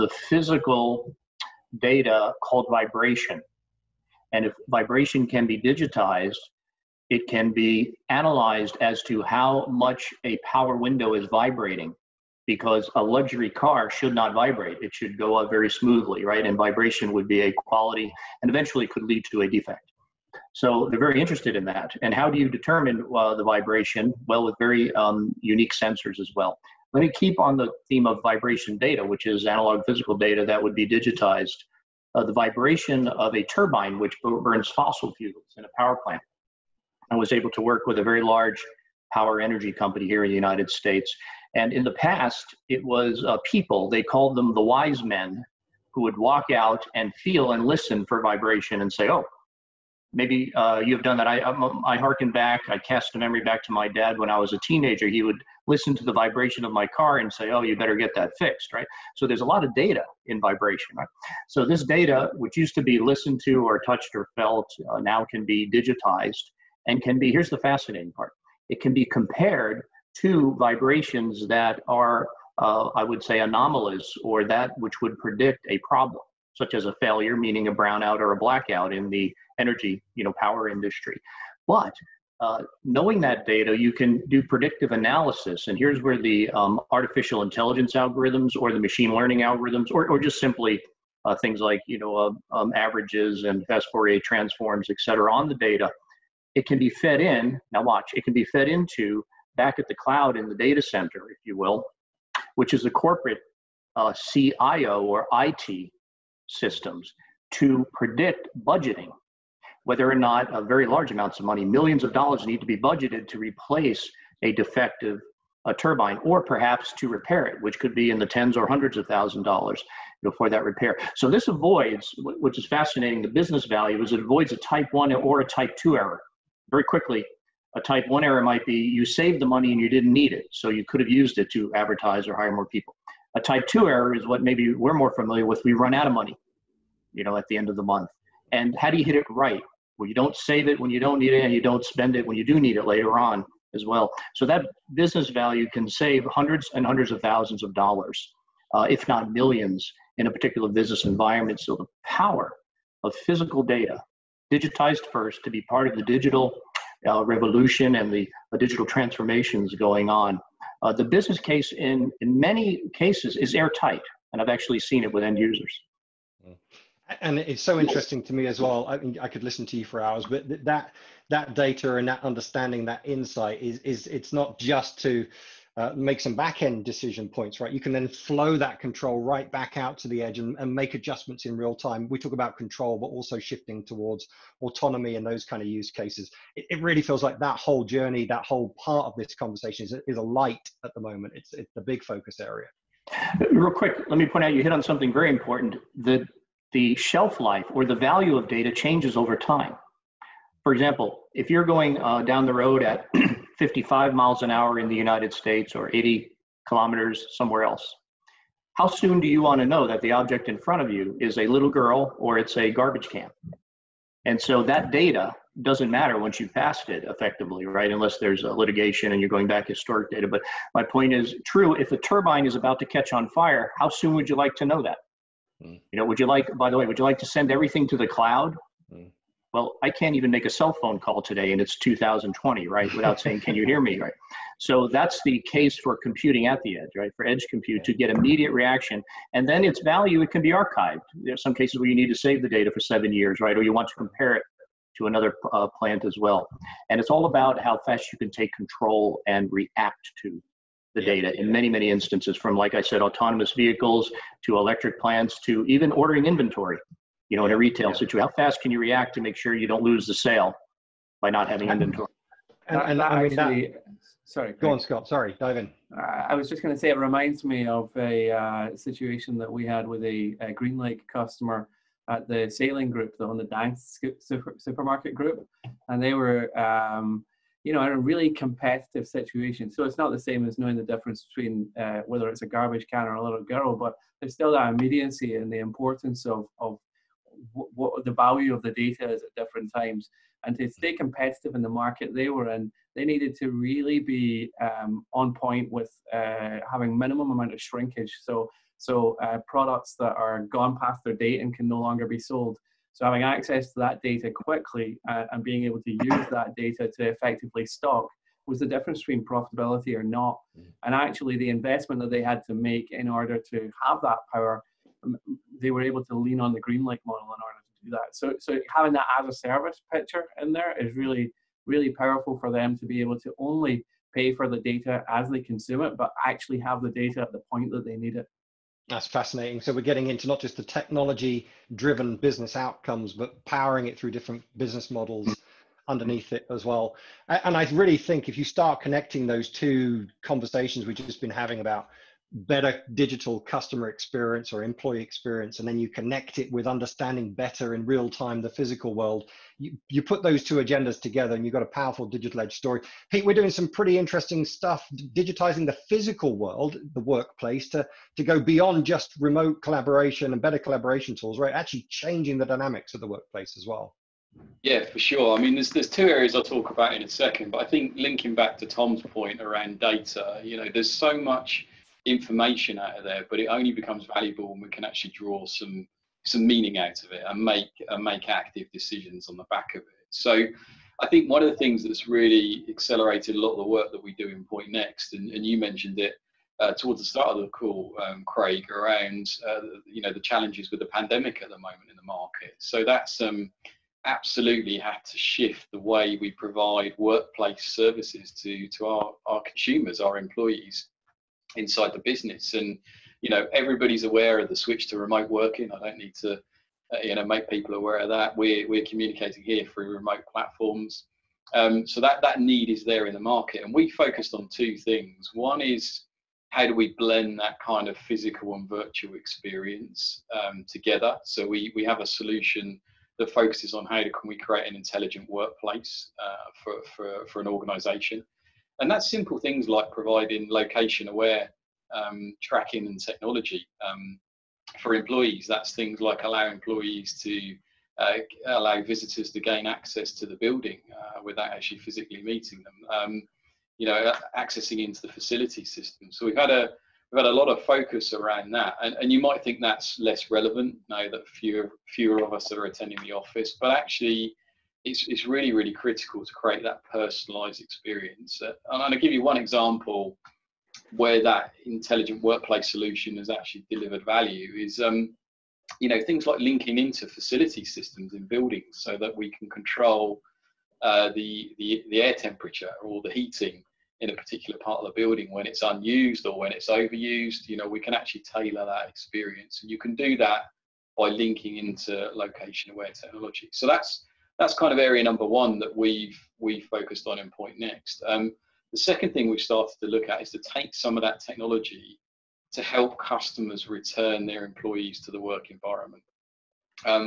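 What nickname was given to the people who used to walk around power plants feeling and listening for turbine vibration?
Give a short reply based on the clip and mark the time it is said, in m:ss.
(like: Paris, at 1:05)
the wise men, at 0:44.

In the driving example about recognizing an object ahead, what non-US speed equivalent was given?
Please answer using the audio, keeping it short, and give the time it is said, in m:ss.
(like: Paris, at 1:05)
80 kilometers, at 3:25.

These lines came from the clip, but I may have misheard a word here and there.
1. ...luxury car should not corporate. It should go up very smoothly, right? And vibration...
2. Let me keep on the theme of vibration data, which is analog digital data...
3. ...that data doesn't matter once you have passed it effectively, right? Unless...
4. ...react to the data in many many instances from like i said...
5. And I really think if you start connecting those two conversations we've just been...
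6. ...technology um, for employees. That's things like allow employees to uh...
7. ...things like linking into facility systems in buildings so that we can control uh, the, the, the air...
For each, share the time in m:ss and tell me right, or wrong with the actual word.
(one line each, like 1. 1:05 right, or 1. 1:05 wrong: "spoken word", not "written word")
1. 0:13 wrong: "vibrate", not "corporate"
2. 0:26 wrong: "physical", not "digital"
3. 3:34 right
4. 4:09 right
5. 5:37 right
6. 7:12 right
7. 7:46 right.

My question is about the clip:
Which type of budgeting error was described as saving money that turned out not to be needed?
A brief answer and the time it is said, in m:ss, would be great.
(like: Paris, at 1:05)
type one error, at 2:07.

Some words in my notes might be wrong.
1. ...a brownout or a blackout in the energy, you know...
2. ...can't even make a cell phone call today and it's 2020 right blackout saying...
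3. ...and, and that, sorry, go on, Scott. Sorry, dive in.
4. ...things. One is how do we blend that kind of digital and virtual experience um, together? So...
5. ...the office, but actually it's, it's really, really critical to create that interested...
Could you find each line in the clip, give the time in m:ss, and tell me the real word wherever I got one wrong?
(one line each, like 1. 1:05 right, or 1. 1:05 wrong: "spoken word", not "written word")
1. 1:17 right
2. 3:49 wrong: "without", not "blackout"
3. 4:22 right
4. 6:54 wrong: "physical", not "digital"
5. 7:33 wrong: "personalized", not "interested".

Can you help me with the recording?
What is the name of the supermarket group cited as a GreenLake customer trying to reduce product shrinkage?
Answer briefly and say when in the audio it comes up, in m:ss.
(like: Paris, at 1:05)
Salling group, at 4:32.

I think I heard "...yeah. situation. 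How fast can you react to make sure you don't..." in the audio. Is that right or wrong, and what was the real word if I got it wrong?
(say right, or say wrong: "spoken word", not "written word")
right.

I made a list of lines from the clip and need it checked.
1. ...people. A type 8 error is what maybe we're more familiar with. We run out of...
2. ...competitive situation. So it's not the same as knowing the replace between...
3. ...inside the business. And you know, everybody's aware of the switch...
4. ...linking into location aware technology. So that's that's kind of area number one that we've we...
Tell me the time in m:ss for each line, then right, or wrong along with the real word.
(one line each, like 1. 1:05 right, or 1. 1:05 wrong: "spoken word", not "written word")
1. 2:12 wrong: "2", not "8"
2. 4:38 wrong: "difference", not "replace"
3. 6:41 right
4. 8:01 right.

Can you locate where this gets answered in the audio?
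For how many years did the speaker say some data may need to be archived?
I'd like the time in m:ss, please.
4:02.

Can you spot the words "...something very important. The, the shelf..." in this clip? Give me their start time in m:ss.
3:14.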